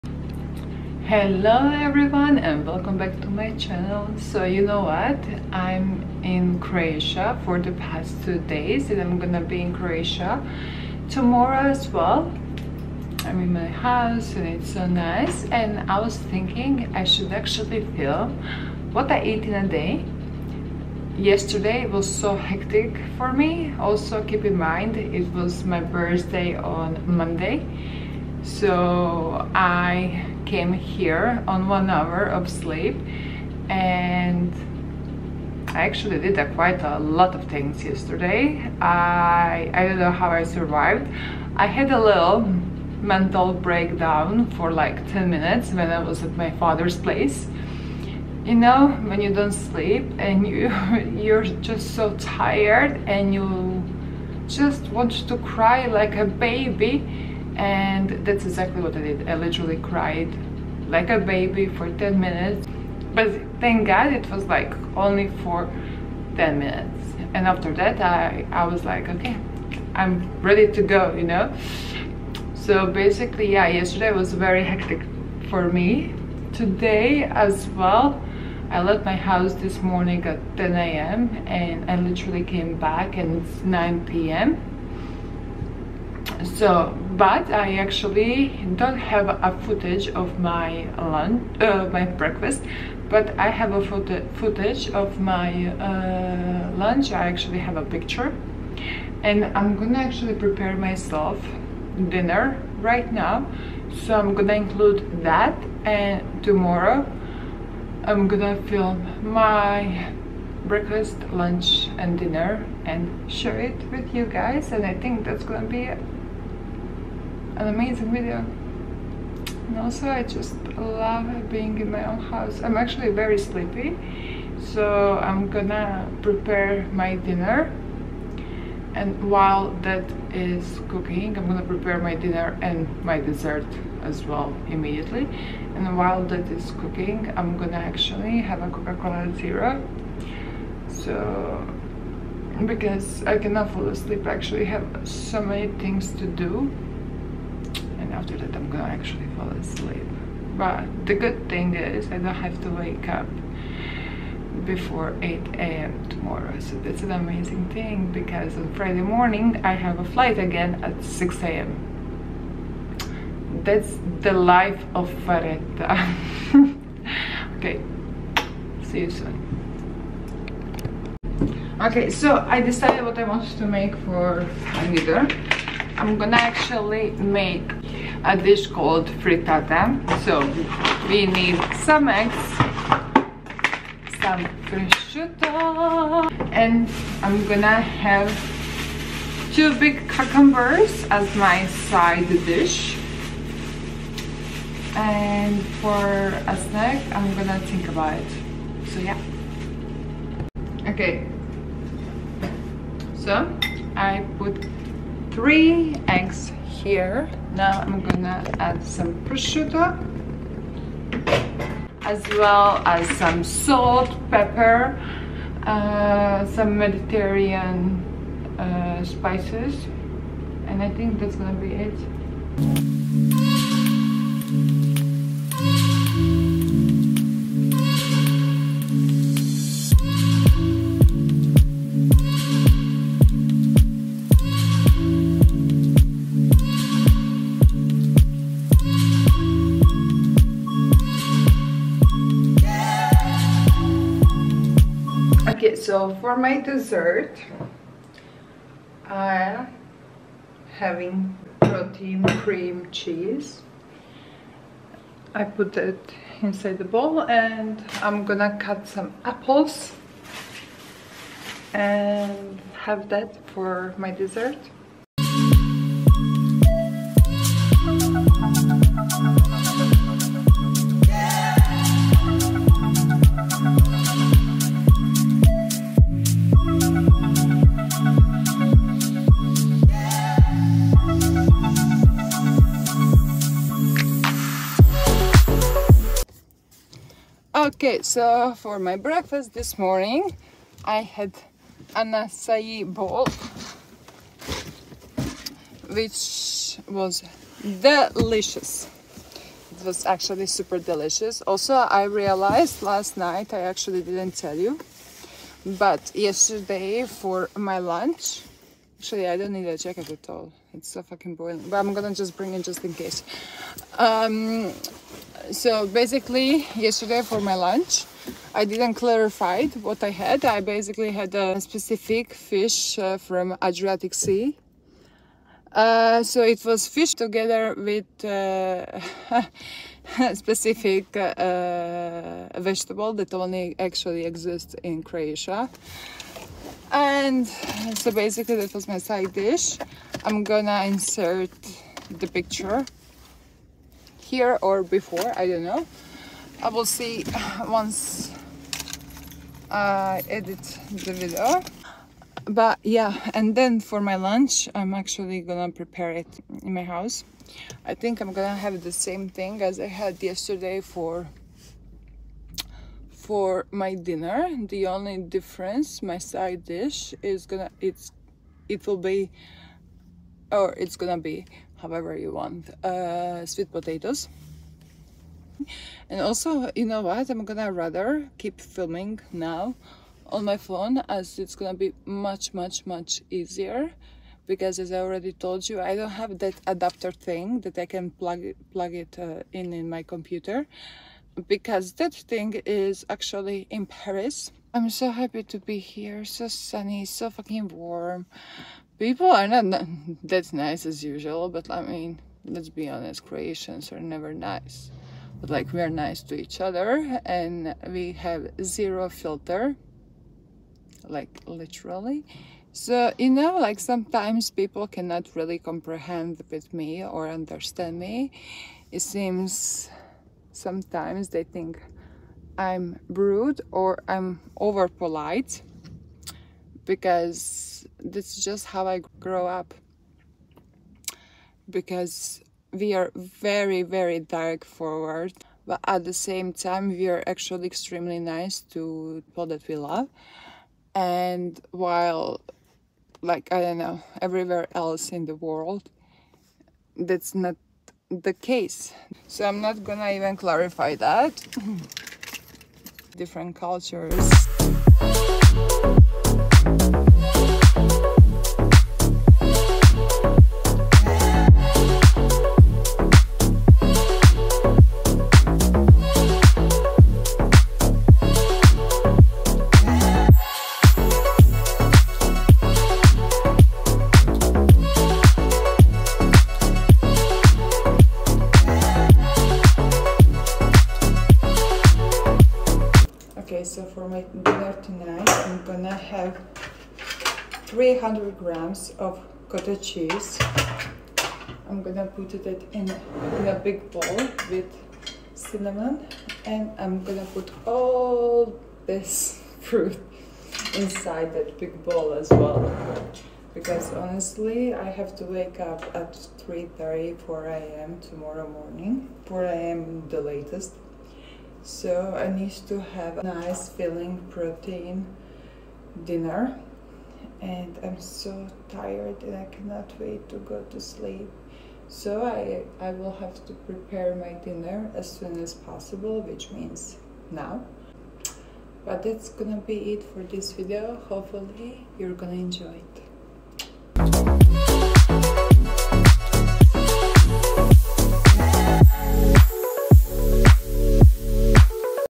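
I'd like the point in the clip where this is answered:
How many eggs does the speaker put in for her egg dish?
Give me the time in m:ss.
3:25.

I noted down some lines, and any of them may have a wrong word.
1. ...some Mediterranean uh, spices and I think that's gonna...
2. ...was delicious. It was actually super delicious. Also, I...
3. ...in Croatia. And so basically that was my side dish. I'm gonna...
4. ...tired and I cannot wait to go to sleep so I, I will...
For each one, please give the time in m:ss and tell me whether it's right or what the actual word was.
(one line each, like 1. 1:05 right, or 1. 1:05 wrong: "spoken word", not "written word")
1. 3:36 right
2. 4:56 right
3. 5:34 right
4. 8:38 right.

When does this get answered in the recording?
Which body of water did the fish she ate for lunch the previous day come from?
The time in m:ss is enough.
5:23.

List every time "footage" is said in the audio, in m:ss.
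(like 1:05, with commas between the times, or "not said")
1:29, 1:34.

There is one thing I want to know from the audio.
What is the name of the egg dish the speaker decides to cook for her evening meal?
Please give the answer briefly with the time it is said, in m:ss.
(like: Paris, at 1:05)
frittata, at 2:59.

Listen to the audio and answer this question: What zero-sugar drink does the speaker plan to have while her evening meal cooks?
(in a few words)
Coca-Cola Zero.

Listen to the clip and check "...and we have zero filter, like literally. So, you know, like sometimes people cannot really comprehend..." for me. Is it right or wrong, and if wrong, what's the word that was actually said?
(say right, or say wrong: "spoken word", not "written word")
right.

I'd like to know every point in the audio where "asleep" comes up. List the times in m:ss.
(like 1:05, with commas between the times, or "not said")
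2:23, 2:29.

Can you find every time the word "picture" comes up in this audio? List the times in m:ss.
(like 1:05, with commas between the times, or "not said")
1:37, 5:42.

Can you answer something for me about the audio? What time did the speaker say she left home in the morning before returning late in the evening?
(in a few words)
10 a.m.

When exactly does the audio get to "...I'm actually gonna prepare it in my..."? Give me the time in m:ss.
5:54.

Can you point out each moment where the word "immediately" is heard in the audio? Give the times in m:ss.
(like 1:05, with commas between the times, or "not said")
2:14.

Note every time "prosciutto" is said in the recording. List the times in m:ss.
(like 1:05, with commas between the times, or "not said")
3:04, 3:29.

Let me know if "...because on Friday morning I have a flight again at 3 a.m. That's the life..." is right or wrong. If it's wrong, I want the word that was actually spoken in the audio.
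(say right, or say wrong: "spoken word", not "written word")
wrong: "6", not "3".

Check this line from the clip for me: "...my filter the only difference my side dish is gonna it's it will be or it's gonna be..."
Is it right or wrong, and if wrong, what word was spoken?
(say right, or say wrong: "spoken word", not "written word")
wrong: "dinner", not "filter".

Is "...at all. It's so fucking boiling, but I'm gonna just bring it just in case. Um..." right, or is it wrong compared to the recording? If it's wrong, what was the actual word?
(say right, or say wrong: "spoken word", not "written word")
right.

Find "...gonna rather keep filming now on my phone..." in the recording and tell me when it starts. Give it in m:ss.
6:17.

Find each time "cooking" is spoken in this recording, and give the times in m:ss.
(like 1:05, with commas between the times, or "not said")
2:10, 2:16.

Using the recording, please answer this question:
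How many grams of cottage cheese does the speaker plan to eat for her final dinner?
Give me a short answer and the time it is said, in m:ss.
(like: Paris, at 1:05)
300, at 8:07.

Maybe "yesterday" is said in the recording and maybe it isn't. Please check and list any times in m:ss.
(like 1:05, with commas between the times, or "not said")
0:21, 0:37, 1:13, 5:06, 5:16, 6:00.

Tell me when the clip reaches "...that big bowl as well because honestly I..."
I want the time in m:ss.
8:21.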